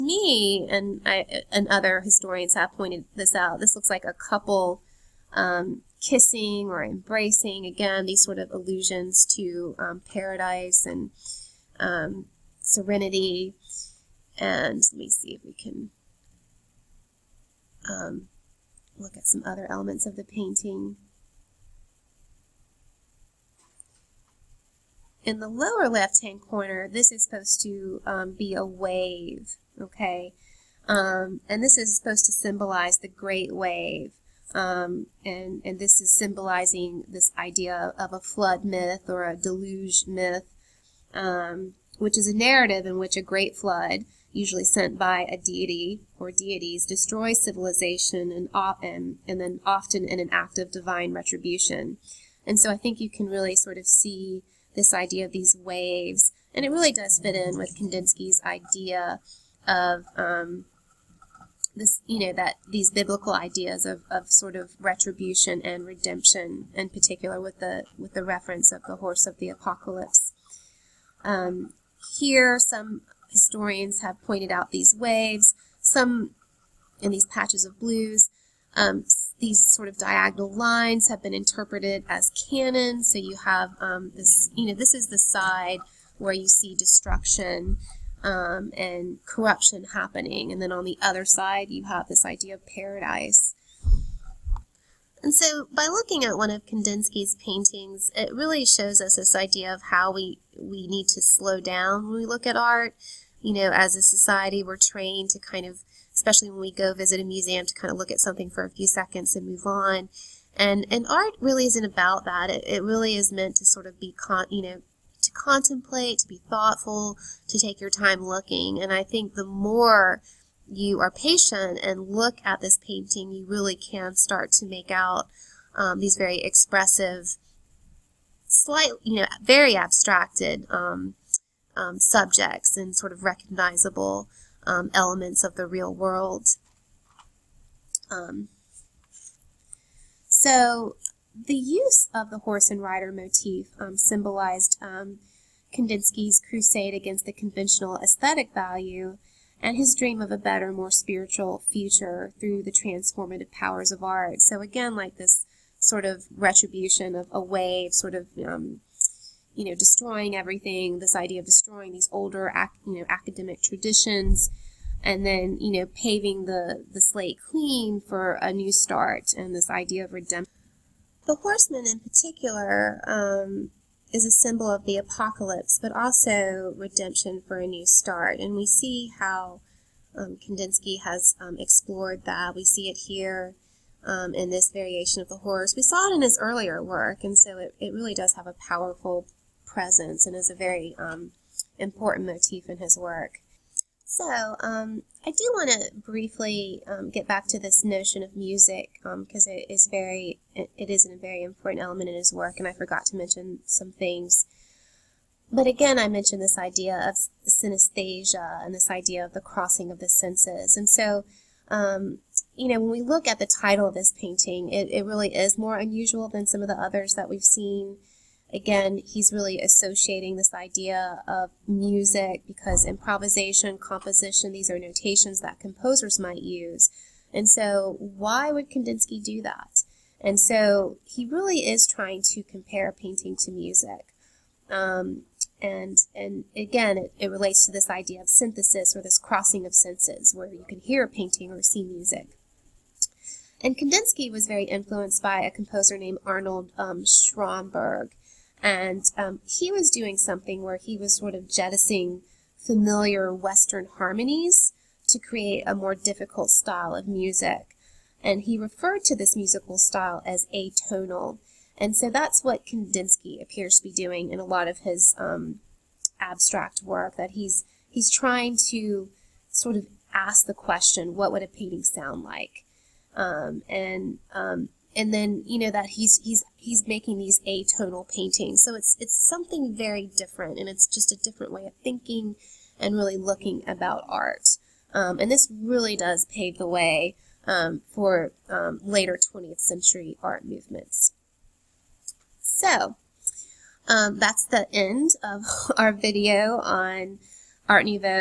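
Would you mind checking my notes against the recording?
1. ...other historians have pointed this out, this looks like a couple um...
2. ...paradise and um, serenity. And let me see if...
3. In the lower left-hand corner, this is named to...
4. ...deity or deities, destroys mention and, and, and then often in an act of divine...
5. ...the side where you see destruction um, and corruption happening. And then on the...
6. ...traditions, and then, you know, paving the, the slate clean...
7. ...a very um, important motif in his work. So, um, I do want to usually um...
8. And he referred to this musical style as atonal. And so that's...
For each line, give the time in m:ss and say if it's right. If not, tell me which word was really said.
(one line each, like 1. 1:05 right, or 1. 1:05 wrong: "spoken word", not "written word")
1. 0:01 right
2. 0:10 right
3. 0:25 wrong: "supposed", not "named"
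4. 0:45 wrong: "civilization", not "mention"
5. 1:25 right
6. 2:43 right
7. 3:10 wrong: "briefly", not "usually"
8. 4:18 right.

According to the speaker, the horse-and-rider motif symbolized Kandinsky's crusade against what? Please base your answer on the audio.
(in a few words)
conventional aesthetic value.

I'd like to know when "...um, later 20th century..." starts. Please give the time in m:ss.
4:48.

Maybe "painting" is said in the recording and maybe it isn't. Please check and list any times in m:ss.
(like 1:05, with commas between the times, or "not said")
0:20, 1:37, 2:02, 3:34, 3:52, 4:01, 4:31, 4:38.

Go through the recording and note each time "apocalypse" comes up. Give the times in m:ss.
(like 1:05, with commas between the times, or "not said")
1:09, 2:54.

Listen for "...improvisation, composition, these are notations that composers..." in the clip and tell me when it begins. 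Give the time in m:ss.
3:42.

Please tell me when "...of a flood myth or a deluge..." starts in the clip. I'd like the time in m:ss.
0:37.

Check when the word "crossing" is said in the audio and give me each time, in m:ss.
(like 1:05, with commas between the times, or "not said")
3:29, 3:59.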